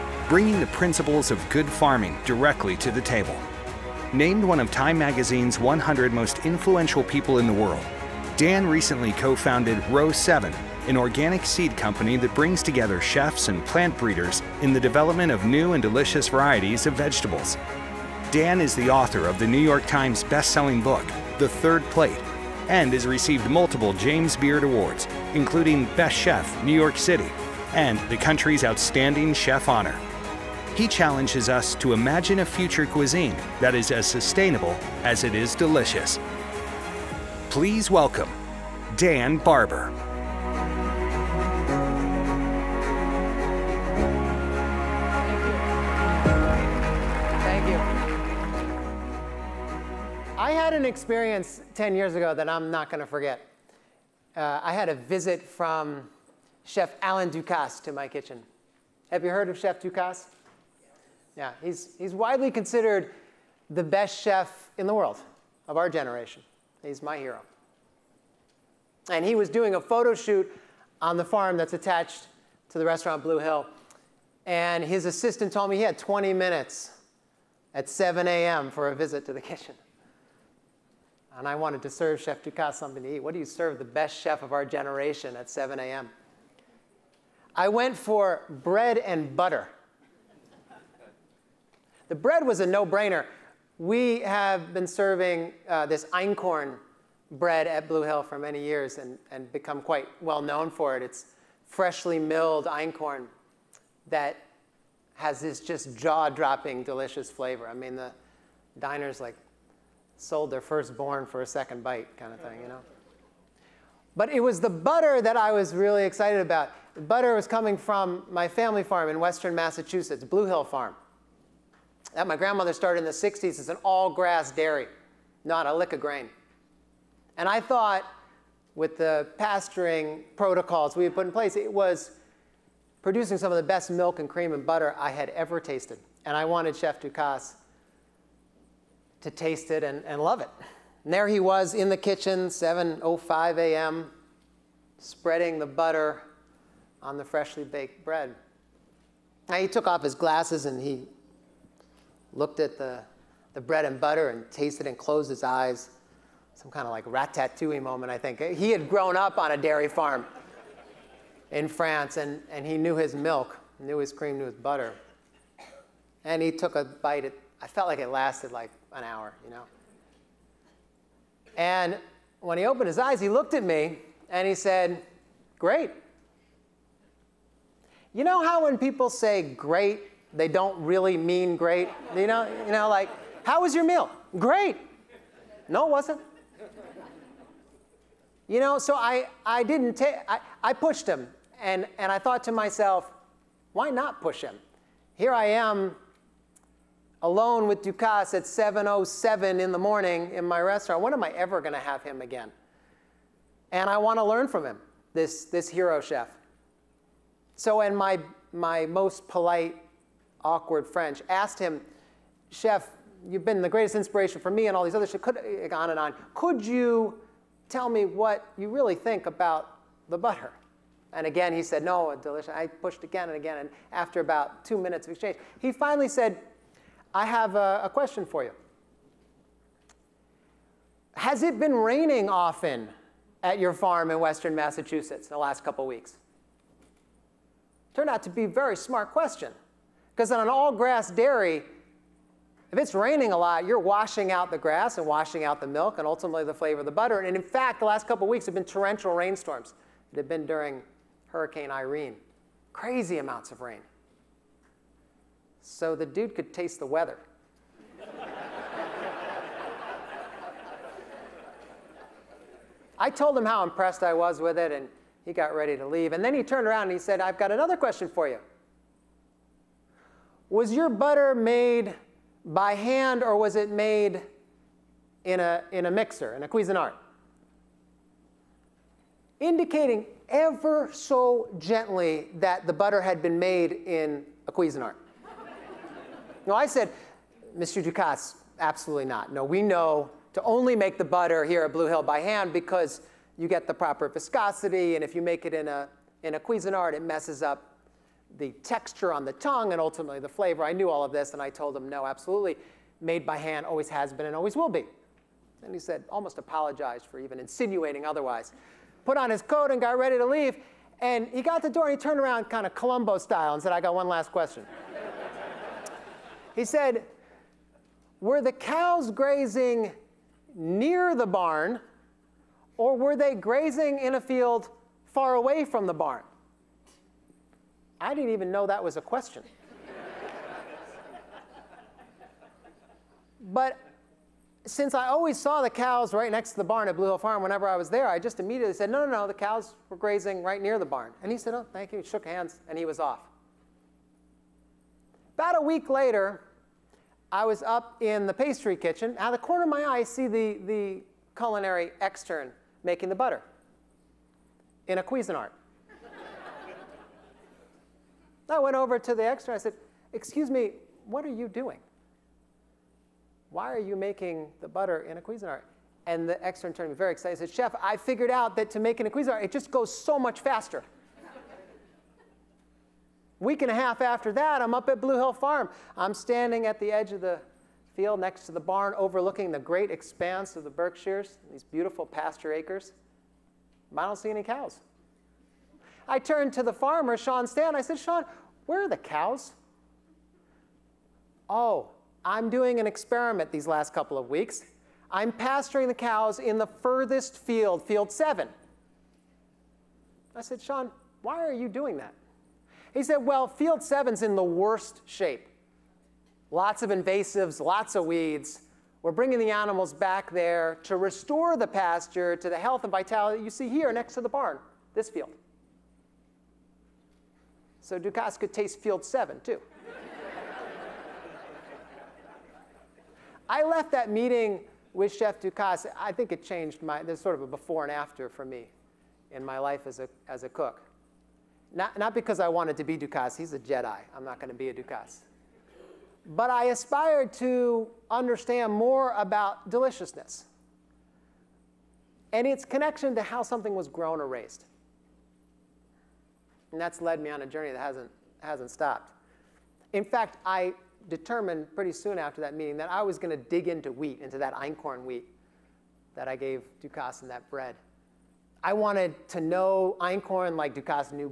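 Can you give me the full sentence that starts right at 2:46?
And he took a bite at I felt like it lasted like an hour, you know?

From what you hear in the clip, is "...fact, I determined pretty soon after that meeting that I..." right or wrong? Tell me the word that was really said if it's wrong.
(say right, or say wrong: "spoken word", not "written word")
right.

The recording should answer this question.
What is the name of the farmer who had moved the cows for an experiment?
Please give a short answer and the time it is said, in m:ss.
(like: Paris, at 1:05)
Sean Stan, at 6:27.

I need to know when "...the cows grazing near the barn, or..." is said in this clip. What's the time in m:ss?
5:18.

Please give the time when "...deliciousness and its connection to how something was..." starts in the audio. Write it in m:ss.
7:19.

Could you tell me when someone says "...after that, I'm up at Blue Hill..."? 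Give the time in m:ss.
6:14.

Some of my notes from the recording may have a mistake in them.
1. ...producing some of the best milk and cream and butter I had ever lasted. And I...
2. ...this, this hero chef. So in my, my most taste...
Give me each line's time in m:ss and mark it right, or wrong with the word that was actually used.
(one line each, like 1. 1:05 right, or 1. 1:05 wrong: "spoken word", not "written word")
1. 2:13 wrong: "tasted", not "lasted"
2. 3:25 wrong: "polite", not "taste".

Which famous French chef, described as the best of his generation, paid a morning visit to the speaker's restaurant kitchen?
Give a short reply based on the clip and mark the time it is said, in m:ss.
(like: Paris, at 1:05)
Alain Ducasse, at 0:57.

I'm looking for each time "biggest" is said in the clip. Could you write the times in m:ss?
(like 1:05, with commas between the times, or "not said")
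not said.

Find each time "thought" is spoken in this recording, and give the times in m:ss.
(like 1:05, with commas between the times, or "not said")
2:07, 3:12.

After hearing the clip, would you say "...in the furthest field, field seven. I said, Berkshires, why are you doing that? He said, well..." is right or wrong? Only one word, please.
wrong.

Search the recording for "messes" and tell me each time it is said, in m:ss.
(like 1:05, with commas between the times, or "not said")
4:57.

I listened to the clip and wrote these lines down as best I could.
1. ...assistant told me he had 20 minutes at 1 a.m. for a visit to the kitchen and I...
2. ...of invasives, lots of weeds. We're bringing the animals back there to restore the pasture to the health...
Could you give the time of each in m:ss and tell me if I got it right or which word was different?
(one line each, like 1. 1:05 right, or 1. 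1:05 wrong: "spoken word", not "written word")
1. 1:15 wrong: "7", not "1"
2. 6:46 right.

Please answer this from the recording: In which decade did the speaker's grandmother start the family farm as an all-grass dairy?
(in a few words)
1960s.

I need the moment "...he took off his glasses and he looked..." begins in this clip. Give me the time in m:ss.
2:29.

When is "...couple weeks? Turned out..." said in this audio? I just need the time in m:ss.
3:55.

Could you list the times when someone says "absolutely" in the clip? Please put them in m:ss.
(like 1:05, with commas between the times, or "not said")
4:48, 5:02.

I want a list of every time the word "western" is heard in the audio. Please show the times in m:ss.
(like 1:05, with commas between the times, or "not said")
1:59, 3:54.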